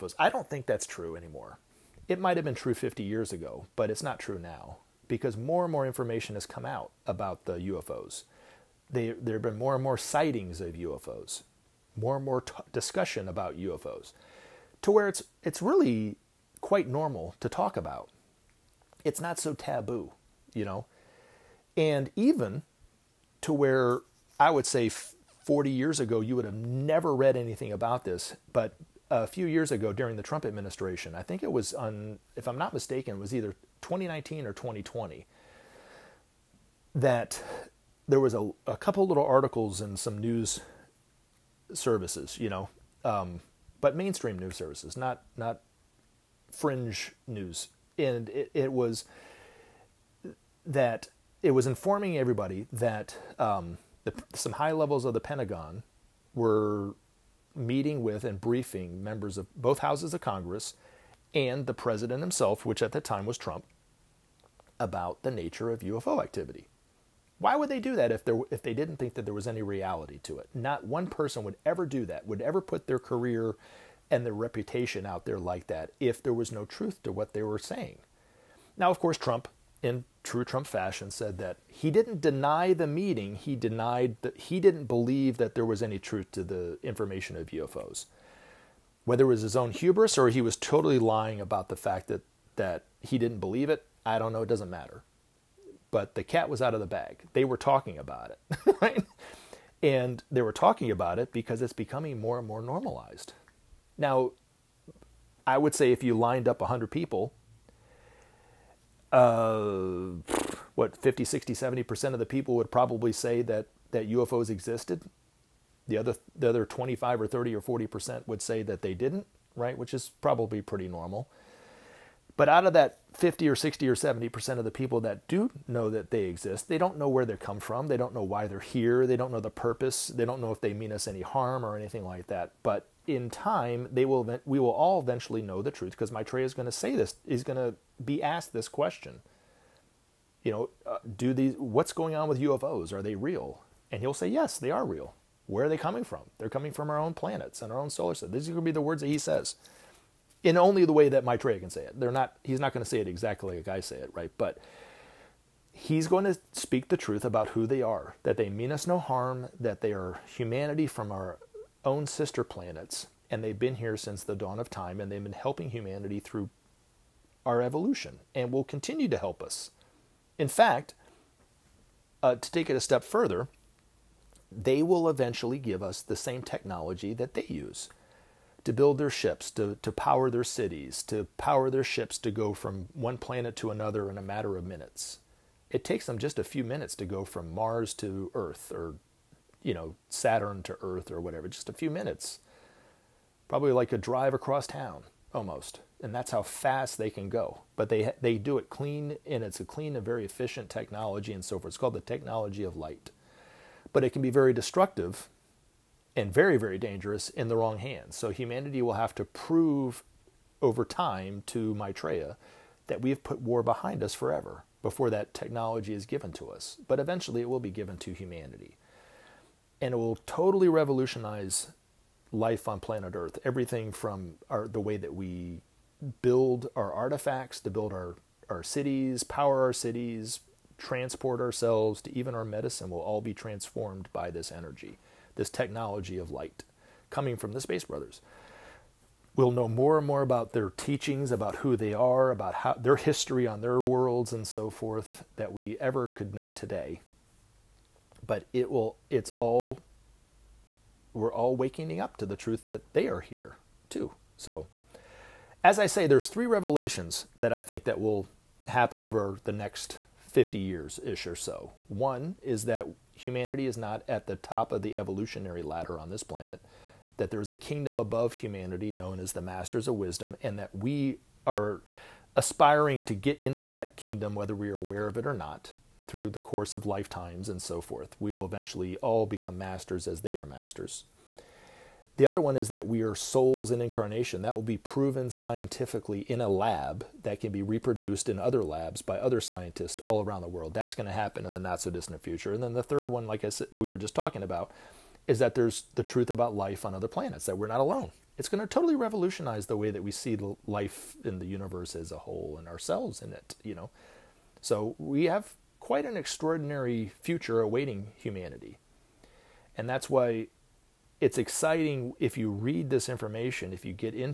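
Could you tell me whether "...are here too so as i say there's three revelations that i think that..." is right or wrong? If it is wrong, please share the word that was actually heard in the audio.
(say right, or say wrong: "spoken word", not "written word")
right.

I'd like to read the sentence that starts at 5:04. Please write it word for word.
So we have quite an extraordinary future awaiting humanity.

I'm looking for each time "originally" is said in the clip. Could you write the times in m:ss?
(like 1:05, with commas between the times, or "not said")
not said.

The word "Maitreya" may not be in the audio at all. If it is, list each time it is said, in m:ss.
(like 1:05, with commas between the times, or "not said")
2:16, 2:31, 3:31.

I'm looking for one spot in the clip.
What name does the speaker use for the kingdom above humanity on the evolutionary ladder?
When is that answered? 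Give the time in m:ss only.
4:29.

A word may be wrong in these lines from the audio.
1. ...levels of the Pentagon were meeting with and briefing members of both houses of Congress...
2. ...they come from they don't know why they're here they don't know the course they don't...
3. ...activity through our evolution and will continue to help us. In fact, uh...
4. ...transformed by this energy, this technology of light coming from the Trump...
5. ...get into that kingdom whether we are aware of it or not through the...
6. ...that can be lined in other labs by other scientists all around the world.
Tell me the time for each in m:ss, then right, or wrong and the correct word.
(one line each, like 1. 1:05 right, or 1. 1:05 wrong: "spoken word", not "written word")
1. 0:54 right
2. 2:07 wrong: "purpose", not "course"
3. 2:45 wrong: "humanity", not "activity"
4. 3:53 wrong: "Space", not "Trump"
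5. 4:33 right
6. 4:47 wrong: "reproduced", not "lined".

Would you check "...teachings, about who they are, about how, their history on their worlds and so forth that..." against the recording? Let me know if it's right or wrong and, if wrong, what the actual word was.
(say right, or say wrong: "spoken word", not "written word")
right.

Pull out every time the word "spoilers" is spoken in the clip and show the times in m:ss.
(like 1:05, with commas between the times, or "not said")
not said.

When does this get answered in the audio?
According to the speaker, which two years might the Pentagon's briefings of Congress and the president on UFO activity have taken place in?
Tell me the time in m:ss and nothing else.
0:33.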